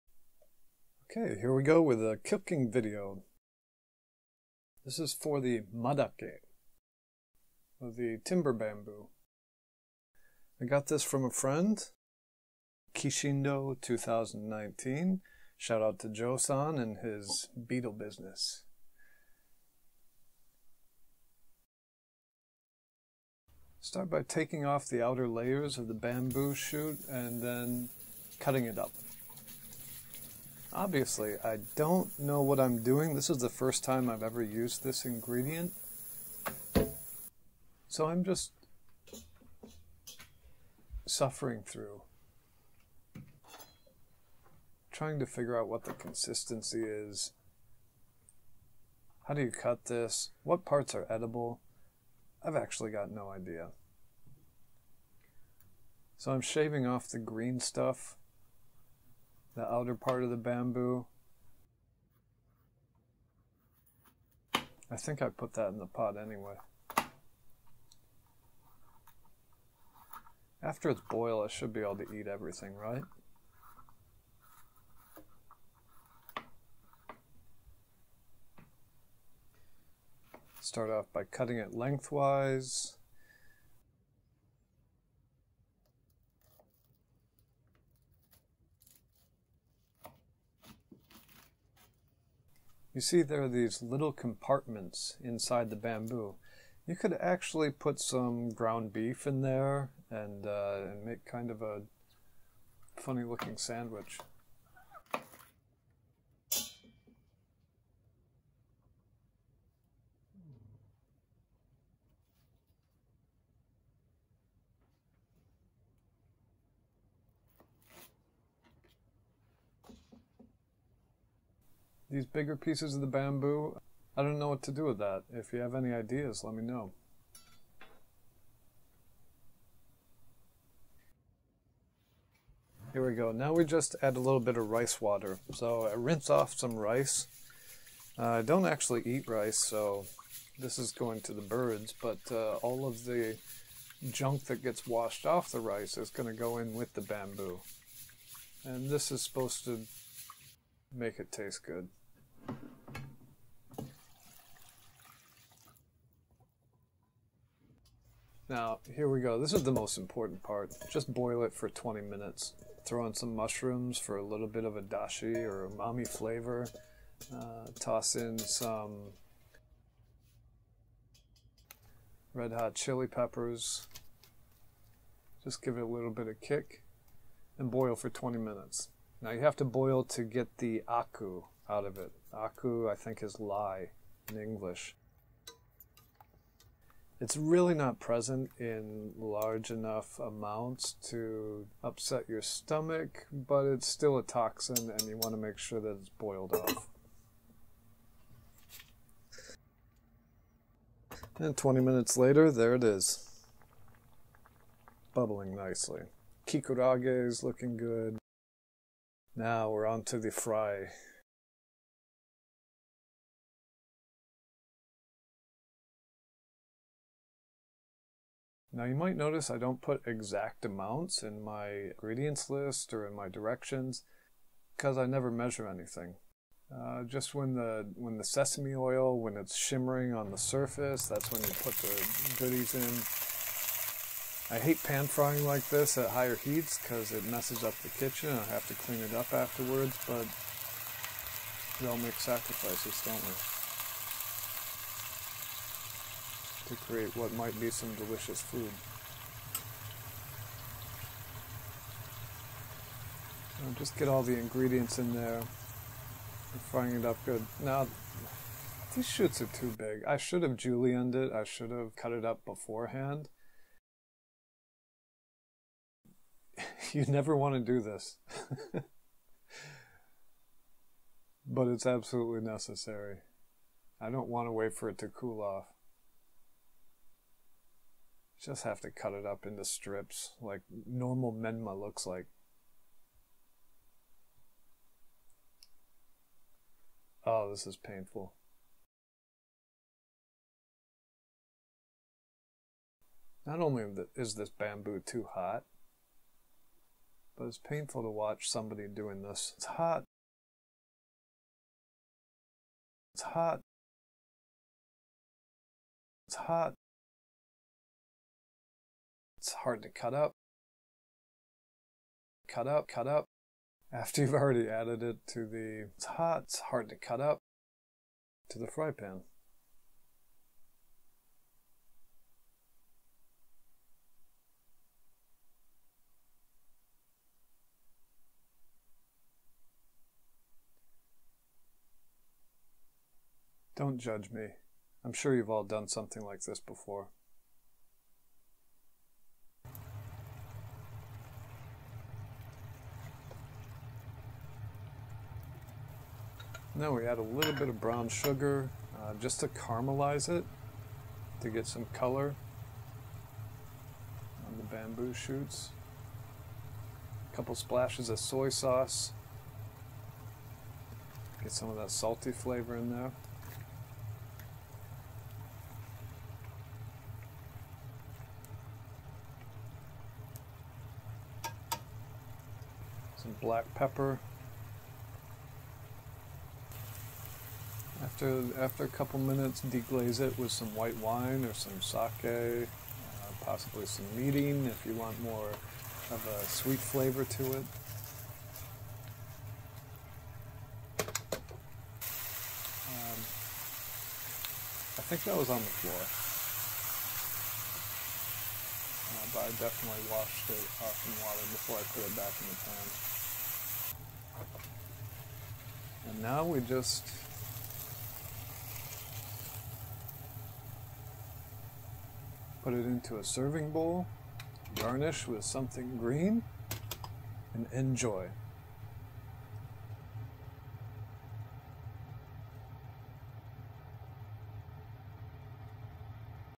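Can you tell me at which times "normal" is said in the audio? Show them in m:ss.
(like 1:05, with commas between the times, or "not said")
4:40.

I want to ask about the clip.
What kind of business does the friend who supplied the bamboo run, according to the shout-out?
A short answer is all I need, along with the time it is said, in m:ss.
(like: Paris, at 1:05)
beetle business, at 0:17.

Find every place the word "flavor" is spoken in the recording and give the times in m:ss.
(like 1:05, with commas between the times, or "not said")
2:46, 6:02, 6:26.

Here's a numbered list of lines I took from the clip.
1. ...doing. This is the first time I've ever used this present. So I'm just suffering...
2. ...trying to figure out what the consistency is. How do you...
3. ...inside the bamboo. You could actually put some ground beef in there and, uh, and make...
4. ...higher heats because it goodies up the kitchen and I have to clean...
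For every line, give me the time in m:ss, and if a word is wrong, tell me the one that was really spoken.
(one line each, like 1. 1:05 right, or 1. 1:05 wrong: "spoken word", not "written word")
1. 0:32 wrong: "ingredient", not "present"
2. 0:44 right
3. 1:35 right
4. 3:56 wrong: "messes", not "goodies".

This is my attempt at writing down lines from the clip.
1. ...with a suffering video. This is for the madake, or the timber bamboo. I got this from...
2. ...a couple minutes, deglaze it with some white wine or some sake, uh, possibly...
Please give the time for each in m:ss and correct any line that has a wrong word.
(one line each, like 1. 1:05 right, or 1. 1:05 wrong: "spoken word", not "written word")
1. 0:01 wrong: "cooking", not "suffering"
2. 6:18 right.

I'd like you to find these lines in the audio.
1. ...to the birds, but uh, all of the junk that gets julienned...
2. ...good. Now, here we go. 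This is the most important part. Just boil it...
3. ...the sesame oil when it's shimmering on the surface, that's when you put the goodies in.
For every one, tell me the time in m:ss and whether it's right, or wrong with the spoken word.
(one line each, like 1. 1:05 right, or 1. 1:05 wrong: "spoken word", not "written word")
1. 2:21 wrong: "washed", not "julienned"
2. 2:31 right
3. 3:48 right.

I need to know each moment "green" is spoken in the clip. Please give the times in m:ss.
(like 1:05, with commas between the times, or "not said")
0:57, 6:55.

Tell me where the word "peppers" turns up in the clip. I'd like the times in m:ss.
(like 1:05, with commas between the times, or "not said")
2:53, 6:13.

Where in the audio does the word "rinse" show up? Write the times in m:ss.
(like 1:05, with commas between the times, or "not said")
2:15.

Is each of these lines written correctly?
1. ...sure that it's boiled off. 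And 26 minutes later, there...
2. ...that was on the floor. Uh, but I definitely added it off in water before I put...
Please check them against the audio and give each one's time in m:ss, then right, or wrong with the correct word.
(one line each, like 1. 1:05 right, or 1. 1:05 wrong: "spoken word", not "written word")
1. 3:15 wrong: "20", not "26"
2. 6:35 wrong: "washed", not "added".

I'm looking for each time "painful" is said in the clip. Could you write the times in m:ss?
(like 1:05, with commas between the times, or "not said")
4:47, 4:57.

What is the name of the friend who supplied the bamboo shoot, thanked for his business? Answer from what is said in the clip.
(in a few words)
Joe-san.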